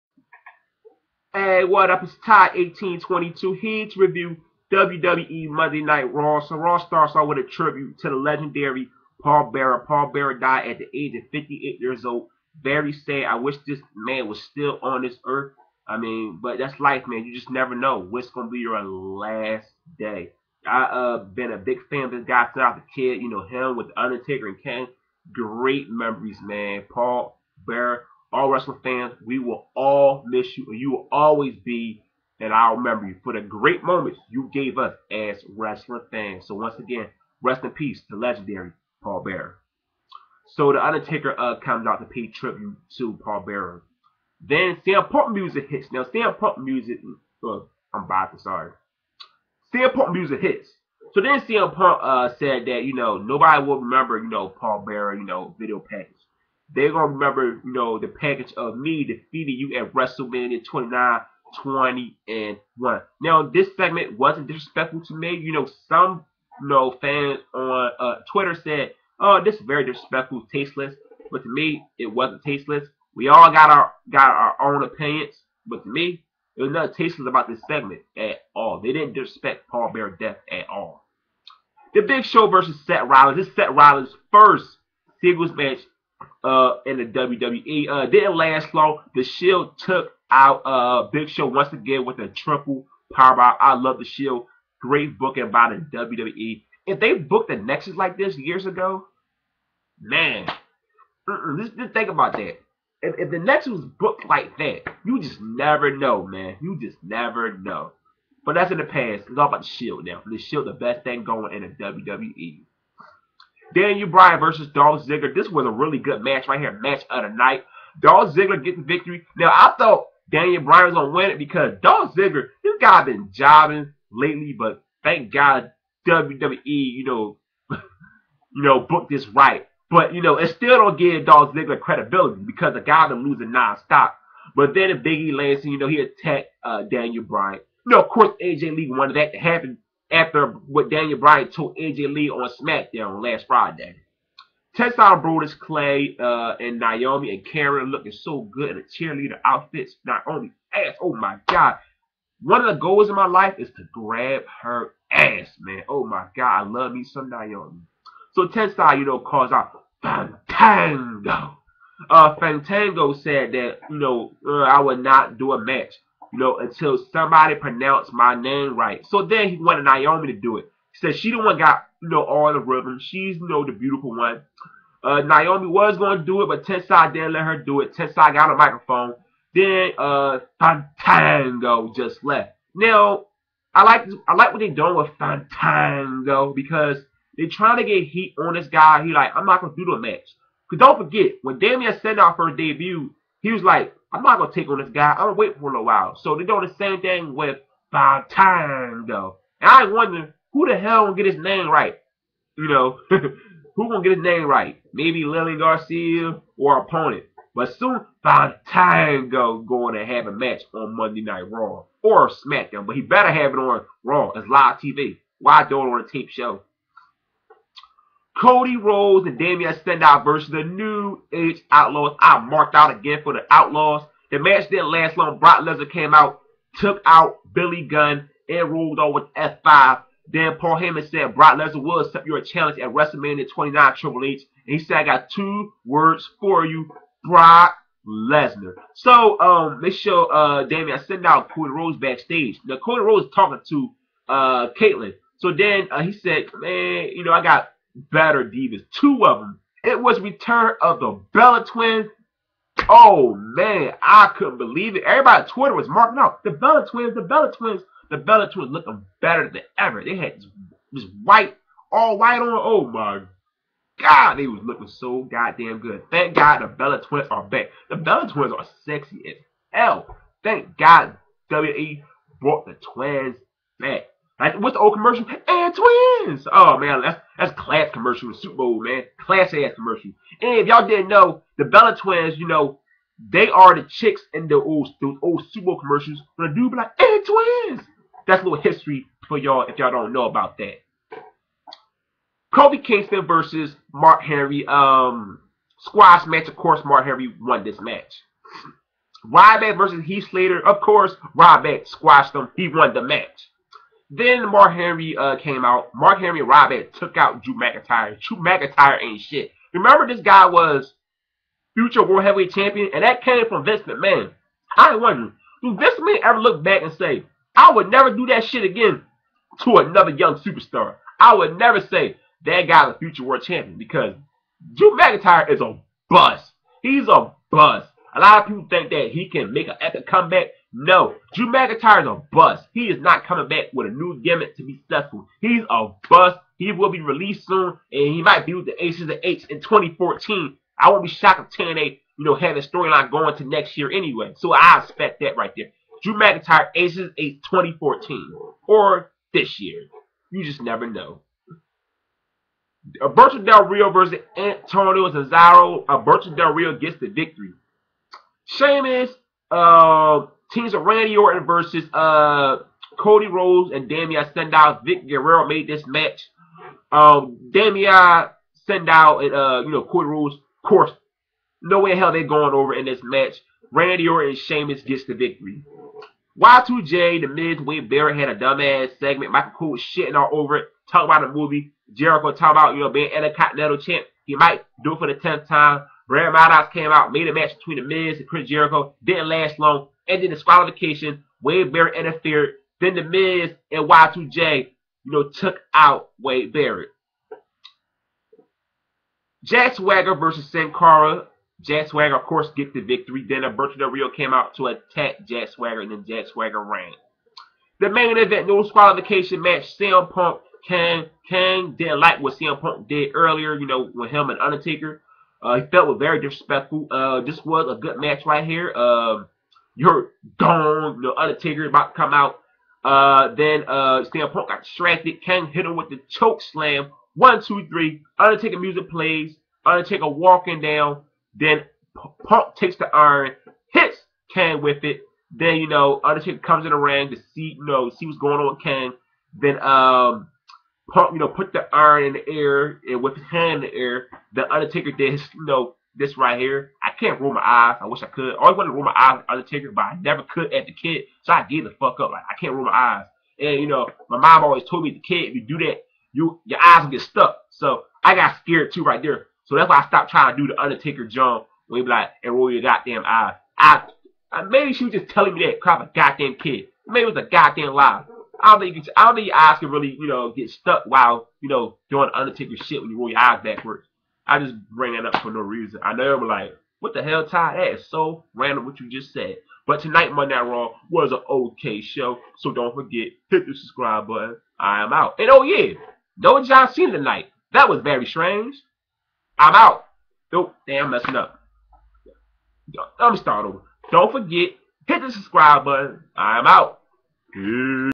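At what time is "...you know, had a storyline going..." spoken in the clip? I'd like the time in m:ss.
5:42.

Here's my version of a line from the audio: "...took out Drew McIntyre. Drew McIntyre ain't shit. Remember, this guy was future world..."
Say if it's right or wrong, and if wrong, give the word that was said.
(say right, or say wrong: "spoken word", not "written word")
right.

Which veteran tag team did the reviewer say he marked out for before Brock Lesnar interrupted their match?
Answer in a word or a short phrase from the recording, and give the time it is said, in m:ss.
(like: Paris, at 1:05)
the New Age Outlaws, at 3:40.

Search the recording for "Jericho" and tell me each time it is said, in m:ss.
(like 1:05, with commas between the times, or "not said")
6:21, 6:28.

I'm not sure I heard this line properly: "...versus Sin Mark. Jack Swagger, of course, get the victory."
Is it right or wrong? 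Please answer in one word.
wrong.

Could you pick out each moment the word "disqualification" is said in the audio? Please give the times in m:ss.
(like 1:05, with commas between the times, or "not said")
6:30, 6:48.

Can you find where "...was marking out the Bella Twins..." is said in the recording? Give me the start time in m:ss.
4:15.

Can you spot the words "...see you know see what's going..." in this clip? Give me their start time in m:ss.
7:17.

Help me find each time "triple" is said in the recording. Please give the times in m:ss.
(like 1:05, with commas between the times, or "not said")
1:32, 3:53.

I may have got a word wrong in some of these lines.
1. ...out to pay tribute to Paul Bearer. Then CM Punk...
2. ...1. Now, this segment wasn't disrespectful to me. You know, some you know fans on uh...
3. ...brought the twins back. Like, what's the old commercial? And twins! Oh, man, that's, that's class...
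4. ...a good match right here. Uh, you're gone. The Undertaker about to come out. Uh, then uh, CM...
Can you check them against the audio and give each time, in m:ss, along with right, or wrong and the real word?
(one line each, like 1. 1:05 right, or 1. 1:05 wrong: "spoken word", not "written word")
1. 0:41 right
2. 1:02 right
3. 4:32 right
4. 6:57 right.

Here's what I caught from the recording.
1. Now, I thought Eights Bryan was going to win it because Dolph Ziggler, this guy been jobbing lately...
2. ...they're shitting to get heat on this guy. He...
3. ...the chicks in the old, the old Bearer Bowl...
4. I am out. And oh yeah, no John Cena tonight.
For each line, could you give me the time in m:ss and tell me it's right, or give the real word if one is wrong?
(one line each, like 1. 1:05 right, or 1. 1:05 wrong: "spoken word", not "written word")
1. 1:59 wrong: "Daniel", not "Eights"
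2. 3:07 wrong: "trying", not "shitting"
3. 4:43 wrong: "Super", not "Bearer"
4. 8:04 right.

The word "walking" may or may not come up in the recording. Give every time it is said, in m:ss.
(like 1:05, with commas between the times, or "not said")
7:10.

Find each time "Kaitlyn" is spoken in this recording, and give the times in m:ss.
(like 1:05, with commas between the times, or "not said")
4:04.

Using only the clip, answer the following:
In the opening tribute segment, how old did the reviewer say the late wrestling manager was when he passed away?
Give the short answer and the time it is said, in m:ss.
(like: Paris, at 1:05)
58, at 0:11.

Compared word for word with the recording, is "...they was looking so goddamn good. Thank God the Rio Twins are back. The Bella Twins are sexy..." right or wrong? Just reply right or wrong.
wrong.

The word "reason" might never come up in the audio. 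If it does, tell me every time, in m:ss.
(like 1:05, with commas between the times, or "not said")
7:55.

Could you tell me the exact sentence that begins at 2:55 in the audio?
Uh, Naomi was going to do it, but Tensai didn't let her do it.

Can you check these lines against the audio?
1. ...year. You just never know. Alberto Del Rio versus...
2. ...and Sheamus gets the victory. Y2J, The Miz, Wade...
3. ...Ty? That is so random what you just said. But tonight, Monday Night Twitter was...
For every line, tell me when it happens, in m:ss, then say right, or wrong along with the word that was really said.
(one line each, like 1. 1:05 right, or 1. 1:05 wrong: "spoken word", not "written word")
1. 5:49 right
2. 6:14 right
3. 7:57 wrong: "Raw", not "Twitter".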